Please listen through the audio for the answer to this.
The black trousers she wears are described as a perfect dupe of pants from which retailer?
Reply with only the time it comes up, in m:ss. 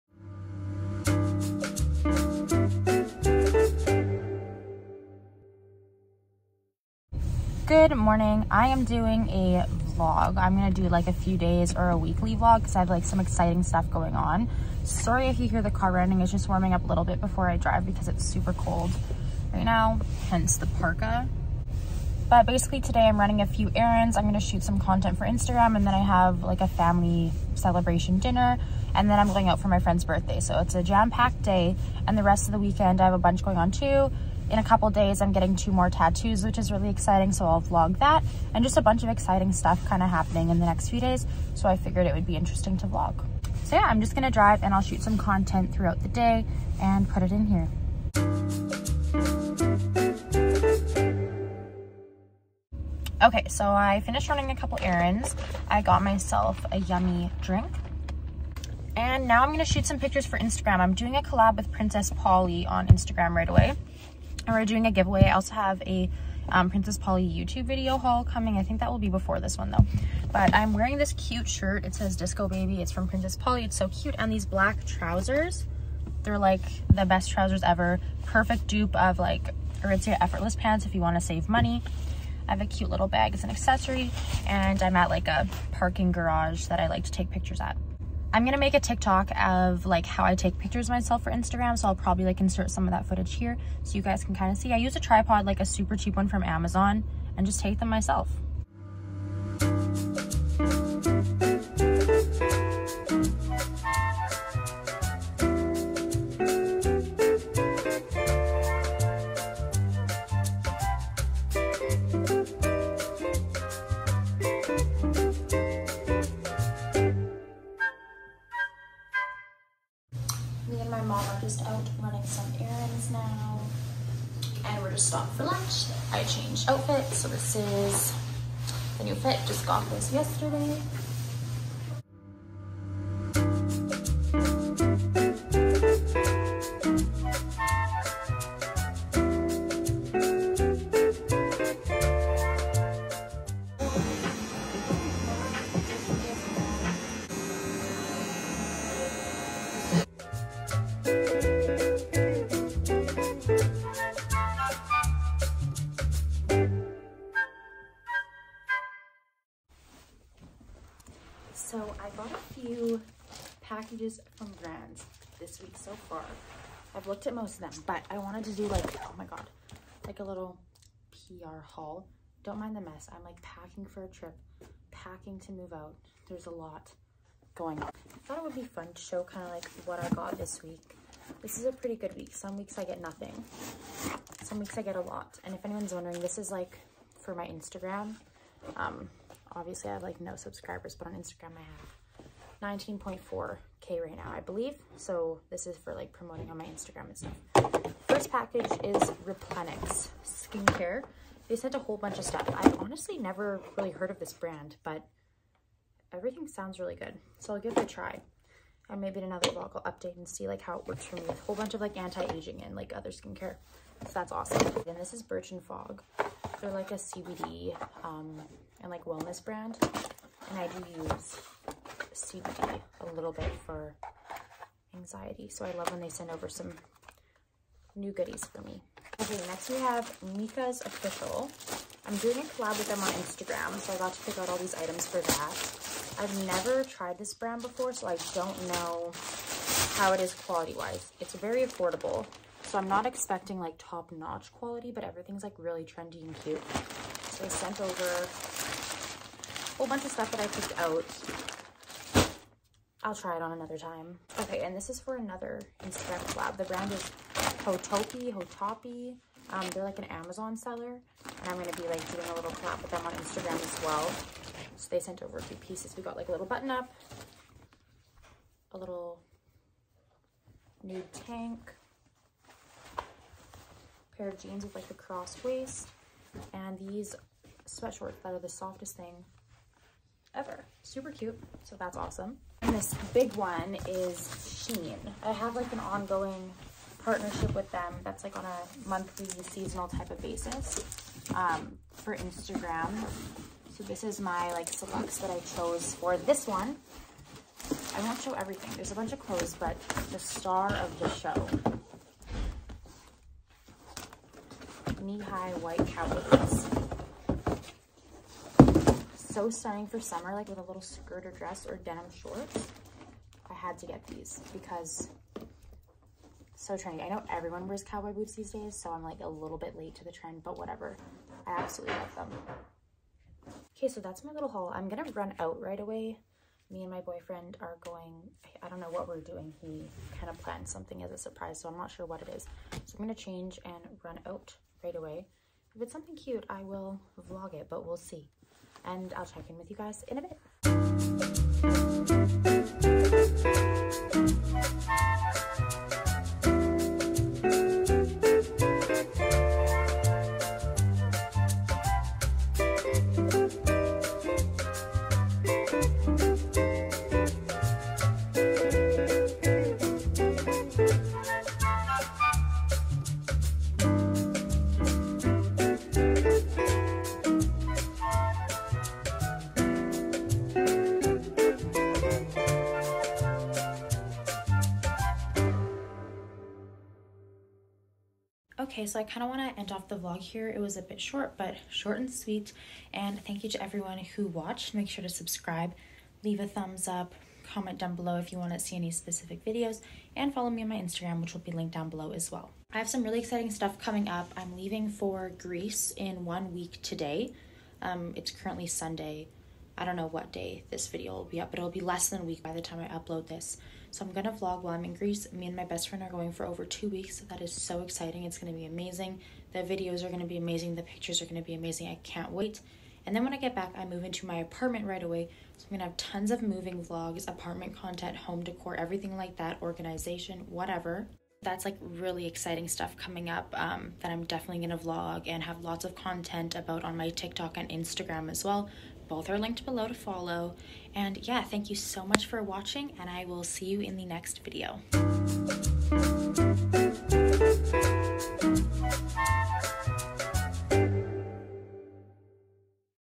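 1:19.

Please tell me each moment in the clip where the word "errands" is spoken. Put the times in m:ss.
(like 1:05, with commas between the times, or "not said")
0:23, 0:54.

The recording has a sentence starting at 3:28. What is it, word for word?
And maybe in another vlog, I'll update and see like how it works for me.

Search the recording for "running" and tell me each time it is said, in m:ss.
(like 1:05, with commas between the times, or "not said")
0:15, 0:23, 0:54.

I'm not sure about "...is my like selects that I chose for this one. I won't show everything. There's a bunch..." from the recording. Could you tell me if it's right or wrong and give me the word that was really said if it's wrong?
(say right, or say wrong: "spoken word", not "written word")
right.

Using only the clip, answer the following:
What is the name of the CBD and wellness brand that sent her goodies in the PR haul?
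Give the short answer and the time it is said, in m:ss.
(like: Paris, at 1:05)
Birch and Fog, at 3:35.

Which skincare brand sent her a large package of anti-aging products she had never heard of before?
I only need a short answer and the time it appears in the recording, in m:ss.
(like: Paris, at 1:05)
Replenix, at 3:19.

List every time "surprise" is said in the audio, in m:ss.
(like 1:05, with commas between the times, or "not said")
5:31.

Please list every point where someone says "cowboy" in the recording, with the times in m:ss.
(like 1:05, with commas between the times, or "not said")
5:05, 5:17.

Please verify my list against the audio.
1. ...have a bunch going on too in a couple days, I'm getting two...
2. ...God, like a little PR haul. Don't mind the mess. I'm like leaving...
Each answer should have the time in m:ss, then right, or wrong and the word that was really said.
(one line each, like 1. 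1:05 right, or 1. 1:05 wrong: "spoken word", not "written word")
1. 0:33 right
2. 2:49 wrong: "packing", not "leaving".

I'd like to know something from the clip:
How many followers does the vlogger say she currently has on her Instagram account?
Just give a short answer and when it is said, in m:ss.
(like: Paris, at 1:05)
19.4k, at 3:12.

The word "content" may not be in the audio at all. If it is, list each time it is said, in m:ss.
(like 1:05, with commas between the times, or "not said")
0:24, 0:45, 6:57, 7:05.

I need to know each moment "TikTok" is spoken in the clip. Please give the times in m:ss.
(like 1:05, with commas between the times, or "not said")
1:28, 7:07.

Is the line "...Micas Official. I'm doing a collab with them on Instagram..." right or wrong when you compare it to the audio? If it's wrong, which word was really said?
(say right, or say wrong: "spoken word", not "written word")
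right.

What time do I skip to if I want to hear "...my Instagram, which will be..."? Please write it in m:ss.
6:30.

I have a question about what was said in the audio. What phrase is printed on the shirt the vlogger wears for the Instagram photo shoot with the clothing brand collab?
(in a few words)
Disco Baby.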